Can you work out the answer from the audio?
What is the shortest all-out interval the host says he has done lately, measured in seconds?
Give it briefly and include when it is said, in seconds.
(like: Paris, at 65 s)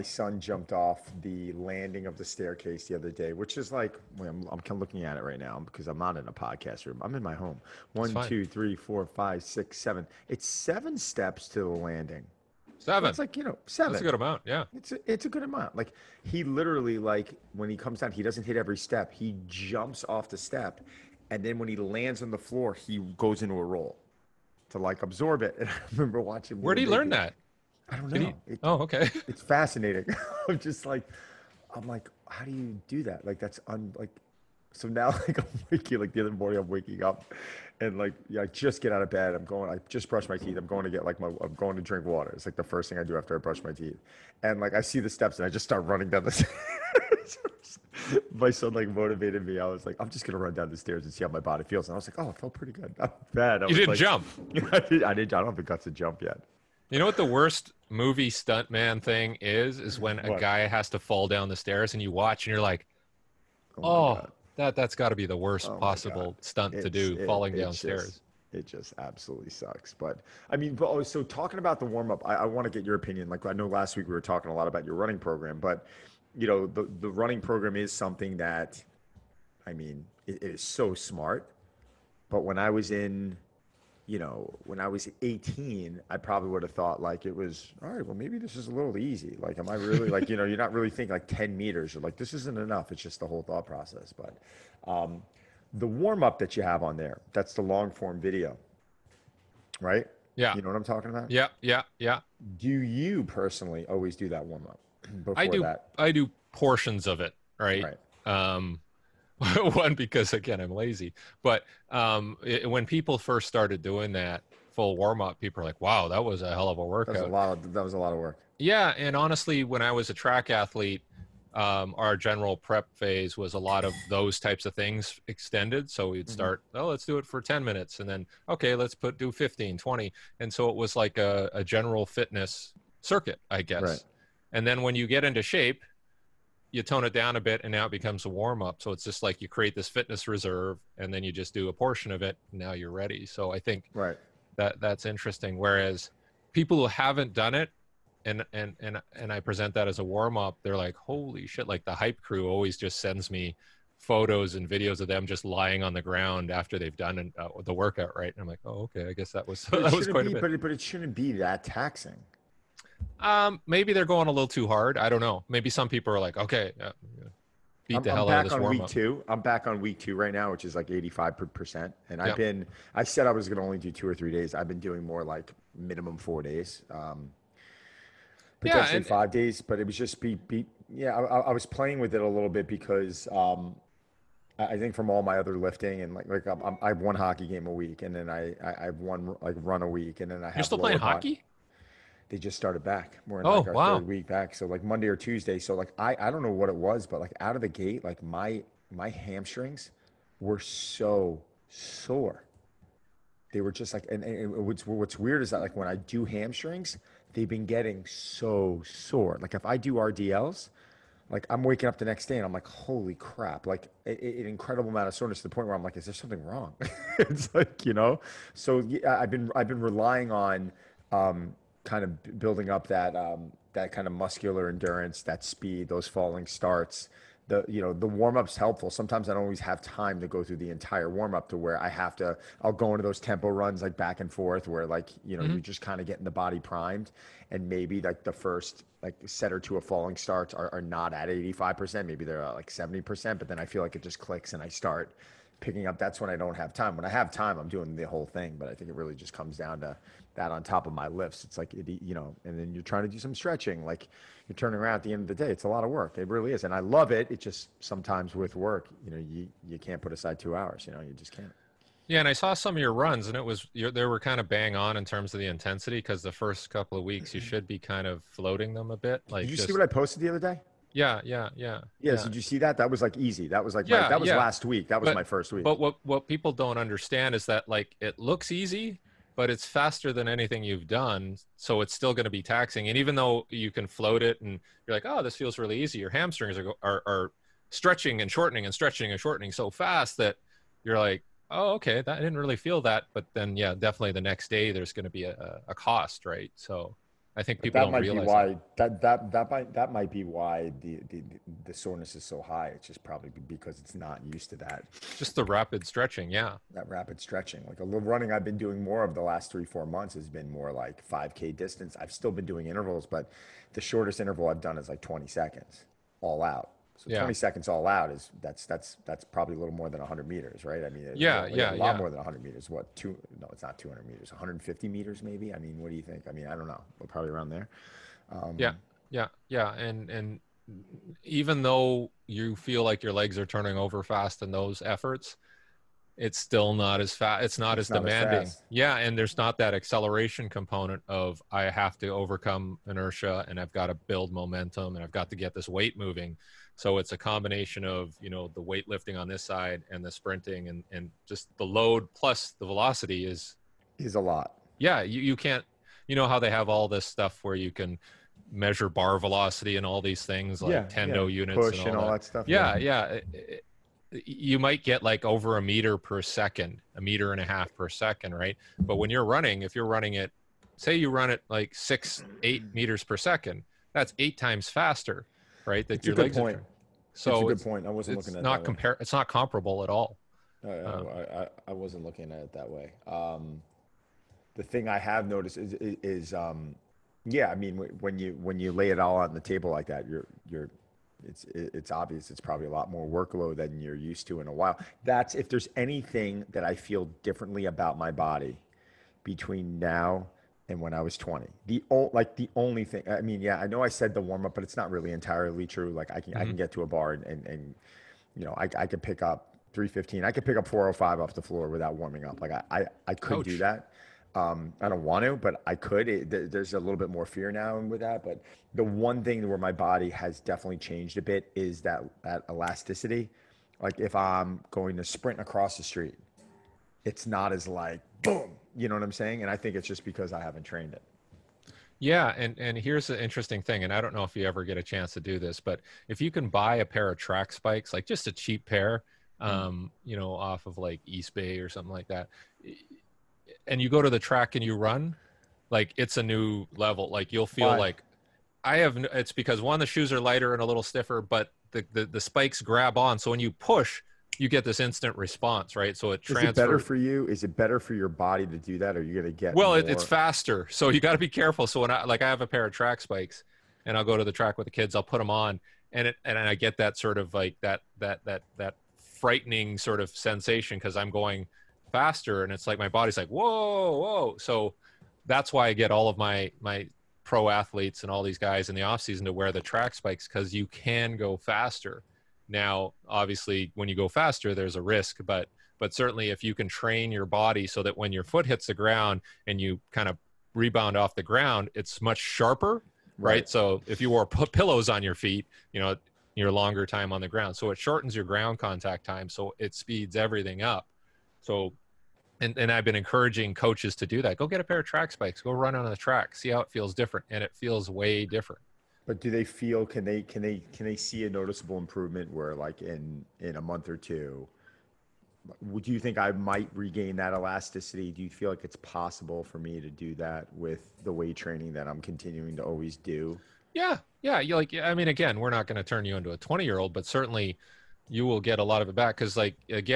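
20 seconds, at 315 s.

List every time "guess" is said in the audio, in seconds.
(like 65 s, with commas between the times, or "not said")
133 s, 159 s.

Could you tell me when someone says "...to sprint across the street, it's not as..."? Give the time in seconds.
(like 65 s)
424 s.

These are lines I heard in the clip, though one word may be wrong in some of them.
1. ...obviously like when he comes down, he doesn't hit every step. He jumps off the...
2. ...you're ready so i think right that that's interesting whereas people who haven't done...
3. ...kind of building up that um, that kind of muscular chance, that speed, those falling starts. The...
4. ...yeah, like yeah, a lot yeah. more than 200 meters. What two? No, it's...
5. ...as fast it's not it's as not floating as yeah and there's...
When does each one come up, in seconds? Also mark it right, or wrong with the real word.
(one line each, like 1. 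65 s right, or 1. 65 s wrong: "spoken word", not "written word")
1. 16 s wrong: "literally", not "obviously"
2. 142 s right
3. 221 s wrong: "endurance", not "chance"
4. 321 s wrong: "100", not "200"
5. 337 s wrong: "demanding", not "floating".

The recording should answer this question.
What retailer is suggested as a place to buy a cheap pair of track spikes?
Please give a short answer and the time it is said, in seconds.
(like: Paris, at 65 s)
Eastbay, at 441 s.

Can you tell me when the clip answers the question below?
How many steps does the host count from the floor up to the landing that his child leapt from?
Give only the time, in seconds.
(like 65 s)
10 s.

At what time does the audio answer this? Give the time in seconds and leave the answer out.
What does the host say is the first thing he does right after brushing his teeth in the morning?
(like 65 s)
41 s.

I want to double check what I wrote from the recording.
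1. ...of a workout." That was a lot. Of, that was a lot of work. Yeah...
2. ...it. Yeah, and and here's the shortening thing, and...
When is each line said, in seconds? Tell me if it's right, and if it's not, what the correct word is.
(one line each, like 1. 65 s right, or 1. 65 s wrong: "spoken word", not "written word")
1. 116 s right
2. 430 s wrong: "interesting", not "shortening".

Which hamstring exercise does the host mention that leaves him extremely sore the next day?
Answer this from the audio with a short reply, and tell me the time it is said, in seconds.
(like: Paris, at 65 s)
RDLs, at 209 s.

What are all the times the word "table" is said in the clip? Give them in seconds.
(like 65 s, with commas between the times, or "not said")
389 s.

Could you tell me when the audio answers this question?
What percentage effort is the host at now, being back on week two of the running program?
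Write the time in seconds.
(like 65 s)
170 s.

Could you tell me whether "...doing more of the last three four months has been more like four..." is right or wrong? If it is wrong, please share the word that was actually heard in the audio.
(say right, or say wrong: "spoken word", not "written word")
wrong: "five", not "four".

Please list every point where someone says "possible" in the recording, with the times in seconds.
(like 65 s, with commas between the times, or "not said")
65 s, 518 s.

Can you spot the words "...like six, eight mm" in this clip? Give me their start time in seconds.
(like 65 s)
371 s.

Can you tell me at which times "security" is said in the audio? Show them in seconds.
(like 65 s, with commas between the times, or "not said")
not said.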